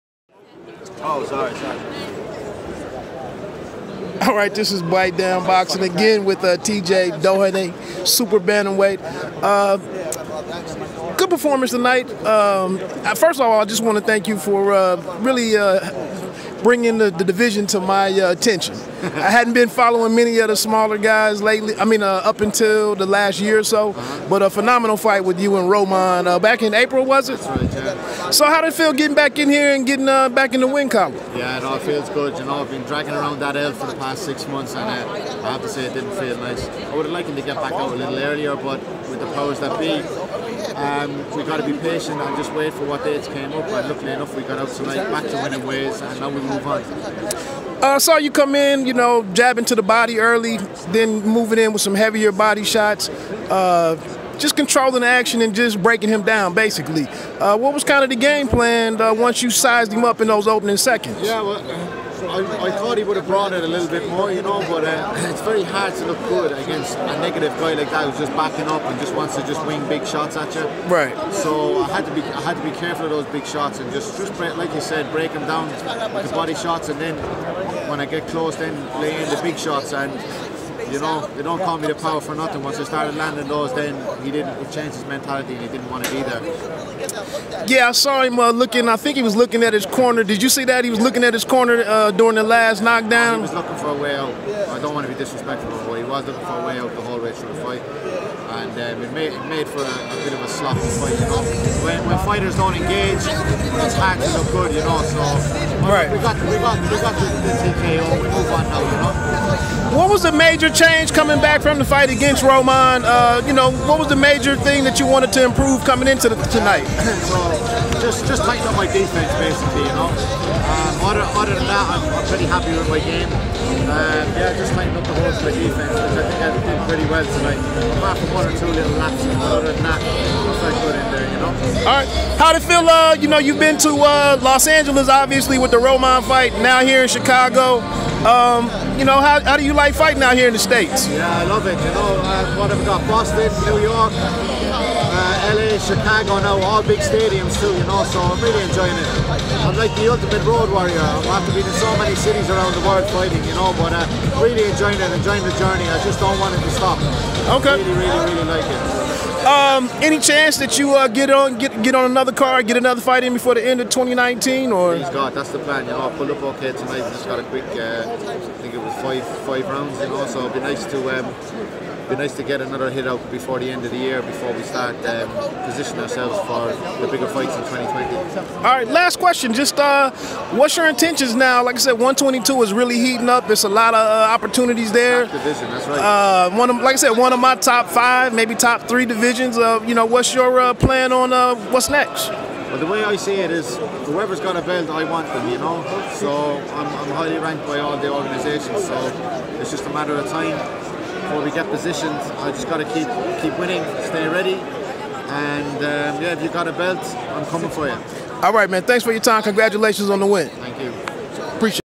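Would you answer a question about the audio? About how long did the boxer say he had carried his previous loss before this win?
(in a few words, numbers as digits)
6 months.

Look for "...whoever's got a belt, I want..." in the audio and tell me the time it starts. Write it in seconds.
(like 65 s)
194 s.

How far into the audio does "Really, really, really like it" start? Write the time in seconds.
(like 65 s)
157 s.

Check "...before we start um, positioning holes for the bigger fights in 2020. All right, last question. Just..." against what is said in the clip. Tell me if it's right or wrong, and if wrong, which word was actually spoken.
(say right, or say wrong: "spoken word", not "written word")
wrong: "ourselves", not "holes".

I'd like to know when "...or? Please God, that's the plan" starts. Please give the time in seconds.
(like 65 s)
164 s.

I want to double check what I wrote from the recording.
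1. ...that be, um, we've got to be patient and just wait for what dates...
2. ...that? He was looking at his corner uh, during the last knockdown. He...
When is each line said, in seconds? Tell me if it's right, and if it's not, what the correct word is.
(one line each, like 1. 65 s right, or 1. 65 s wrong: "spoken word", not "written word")
1. 39 s right
2. 90 s right.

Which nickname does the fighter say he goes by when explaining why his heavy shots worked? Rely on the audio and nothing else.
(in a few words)
The Power.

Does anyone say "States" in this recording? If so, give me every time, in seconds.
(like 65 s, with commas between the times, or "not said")
140 s.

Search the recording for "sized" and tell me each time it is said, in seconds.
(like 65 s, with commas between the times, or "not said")
59 s.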